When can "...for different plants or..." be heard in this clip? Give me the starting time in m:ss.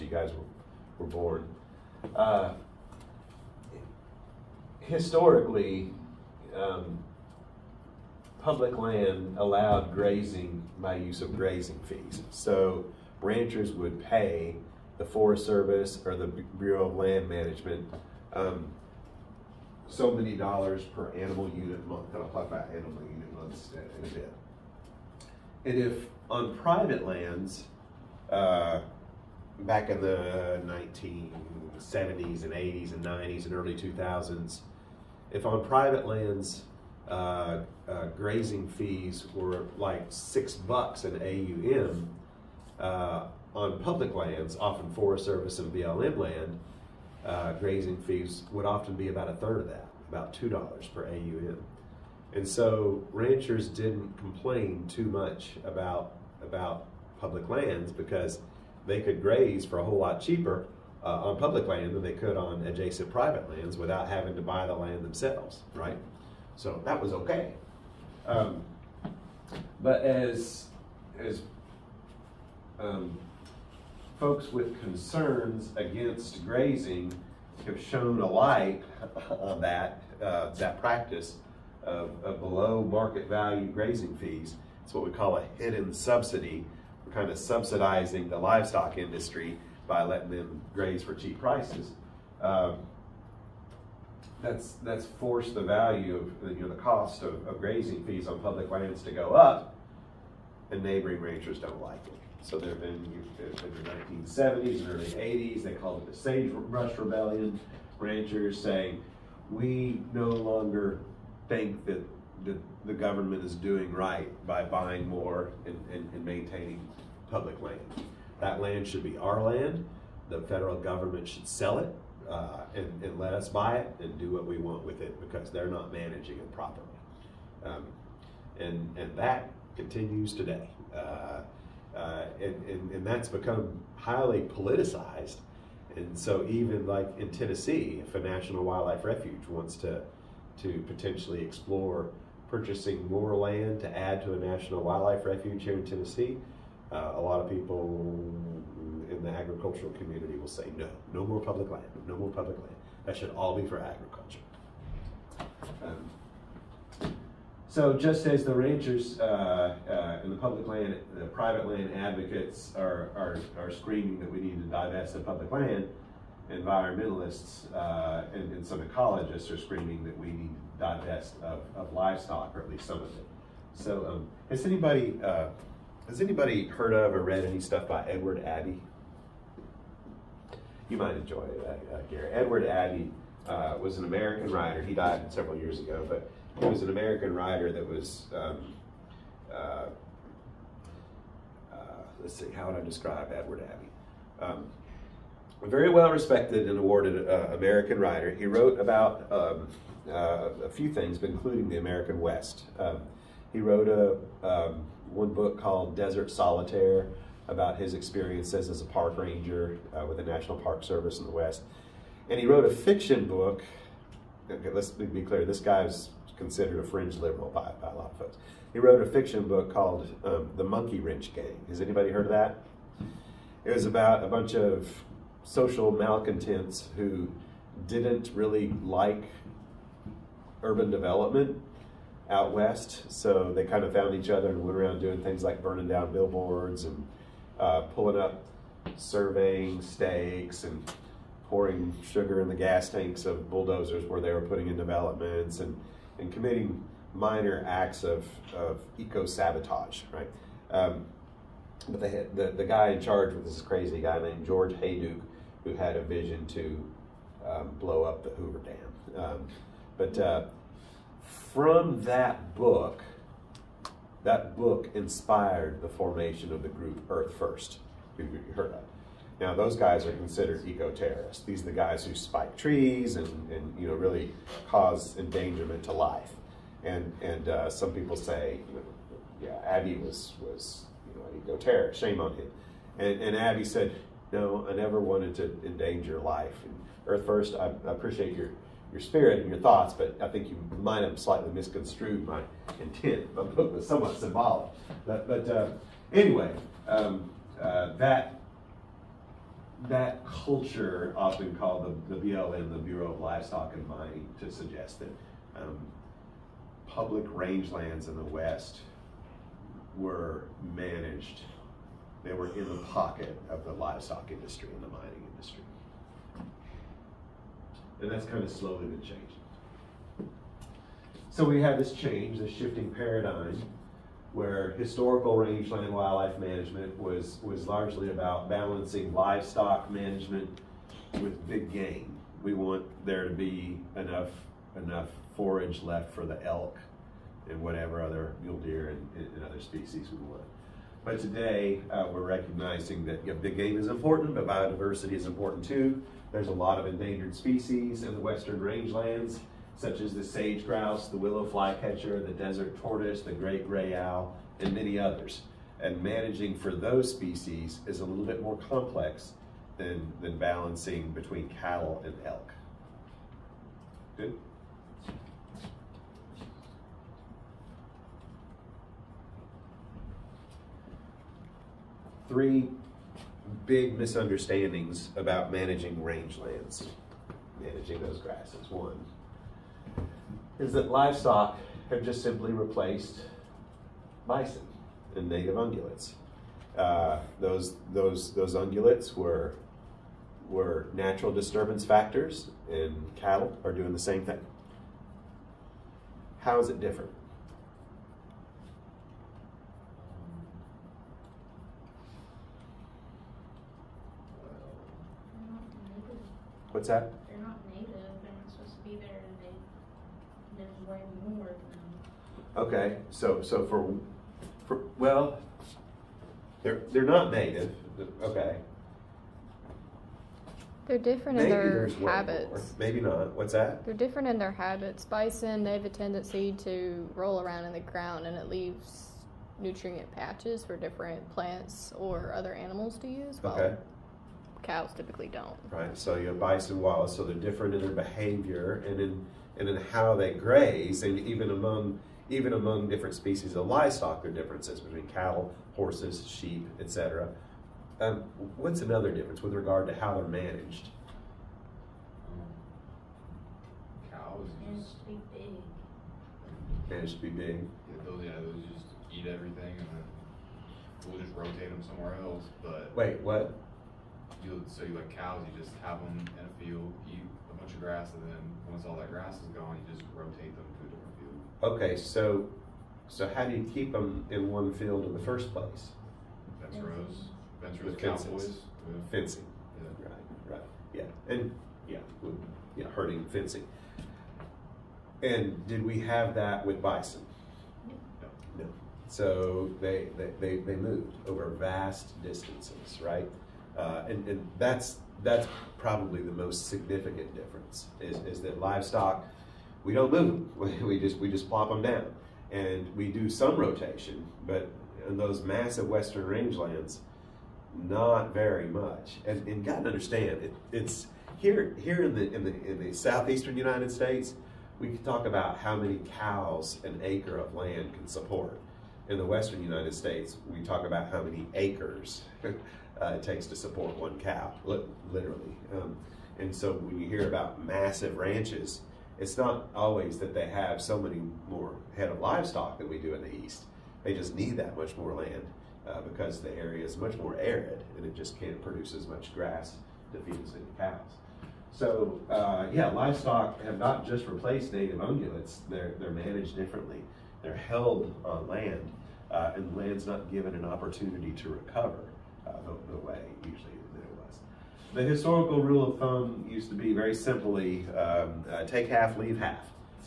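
7:10.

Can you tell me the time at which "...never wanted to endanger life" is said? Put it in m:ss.
4:44.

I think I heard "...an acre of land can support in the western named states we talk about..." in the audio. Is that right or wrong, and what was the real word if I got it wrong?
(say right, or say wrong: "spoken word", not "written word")
wrong: "united", not "named".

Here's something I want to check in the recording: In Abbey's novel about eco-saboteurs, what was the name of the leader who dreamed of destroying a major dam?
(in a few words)
George Hayduke.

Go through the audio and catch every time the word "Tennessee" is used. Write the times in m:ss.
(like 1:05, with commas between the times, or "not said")
2:17, 2:25.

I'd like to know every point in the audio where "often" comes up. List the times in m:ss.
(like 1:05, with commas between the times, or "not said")
0:44, 0:48, 5:01.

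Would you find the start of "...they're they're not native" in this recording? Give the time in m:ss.
6:56.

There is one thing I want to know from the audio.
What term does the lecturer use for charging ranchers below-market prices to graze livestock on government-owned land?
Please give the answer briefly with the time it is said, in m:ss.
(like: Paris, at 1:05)
hidden subsidy, at 1:25.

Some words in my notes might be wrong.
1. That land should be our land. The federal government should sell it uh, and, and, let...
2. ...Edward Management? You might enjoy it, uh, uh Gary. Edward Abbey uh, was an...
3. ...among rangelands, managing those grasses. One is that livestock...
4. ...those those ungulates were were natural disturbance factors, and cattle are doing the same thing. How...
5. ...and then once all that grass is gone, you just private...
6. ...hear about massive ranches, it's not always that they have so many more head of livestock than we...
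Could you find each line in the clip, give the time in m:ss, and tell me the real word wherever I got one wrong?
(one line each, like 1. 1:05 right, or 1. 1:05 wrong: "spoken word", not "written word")
1. 1:58 right
2. 2:58 wrong: "Abbey", not "Management"
3. 6:15 wrong: "managing", not "among"
4. 6:27 right
5. 7:48 wrong: "rotate", not "private"
6. 8:47 right.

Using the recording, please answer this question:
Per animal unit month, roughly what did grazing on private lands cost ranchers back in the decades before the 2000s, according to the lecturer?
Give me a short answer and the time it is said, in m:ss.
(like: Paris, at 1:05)
$6, at 0:40.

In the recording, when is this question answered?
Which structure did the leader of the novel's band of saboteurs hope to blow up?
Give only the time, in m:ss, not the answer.
4:18.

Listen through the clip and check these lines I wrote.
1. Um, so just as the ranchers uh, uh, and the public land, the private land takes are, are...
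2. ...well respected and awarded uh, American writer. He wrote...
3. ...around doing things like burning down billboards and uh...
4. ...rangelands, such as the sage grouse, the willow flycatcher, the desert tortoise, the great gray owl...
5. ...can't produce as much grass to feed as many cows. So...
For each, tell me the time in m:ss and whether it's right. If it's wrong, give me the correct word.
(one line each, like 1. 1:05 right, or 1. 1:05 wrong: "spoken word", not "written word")
1. 2:35 wrong: "advocates", not "takes"
2. 3:15 right
3. 3:54 right
4. 5:48 right
5. 8:58 right.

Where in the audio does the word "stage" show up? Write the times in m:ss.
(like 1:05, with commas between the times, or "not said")
not said.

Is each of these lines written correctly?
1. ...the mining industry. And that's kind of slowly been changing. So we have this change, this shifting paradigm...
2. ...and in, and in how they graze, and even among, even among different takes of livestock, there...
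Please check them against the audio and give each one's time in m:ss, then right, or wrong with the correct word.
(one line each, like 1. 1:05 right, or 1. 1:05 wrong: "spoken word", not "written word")
1. 5:14 right
2. 7:18 wrong: "species", not "takes".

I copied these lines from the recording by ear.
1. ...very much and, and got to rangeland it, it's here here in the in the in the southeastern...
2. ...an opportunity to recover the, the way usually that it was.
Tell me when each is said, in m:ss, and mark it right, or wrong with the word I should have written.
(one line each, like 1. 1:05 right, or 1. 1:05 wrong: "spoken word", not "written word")
1. 8:28 wrong: "understand", not "rangeland"
2. 9:10 right.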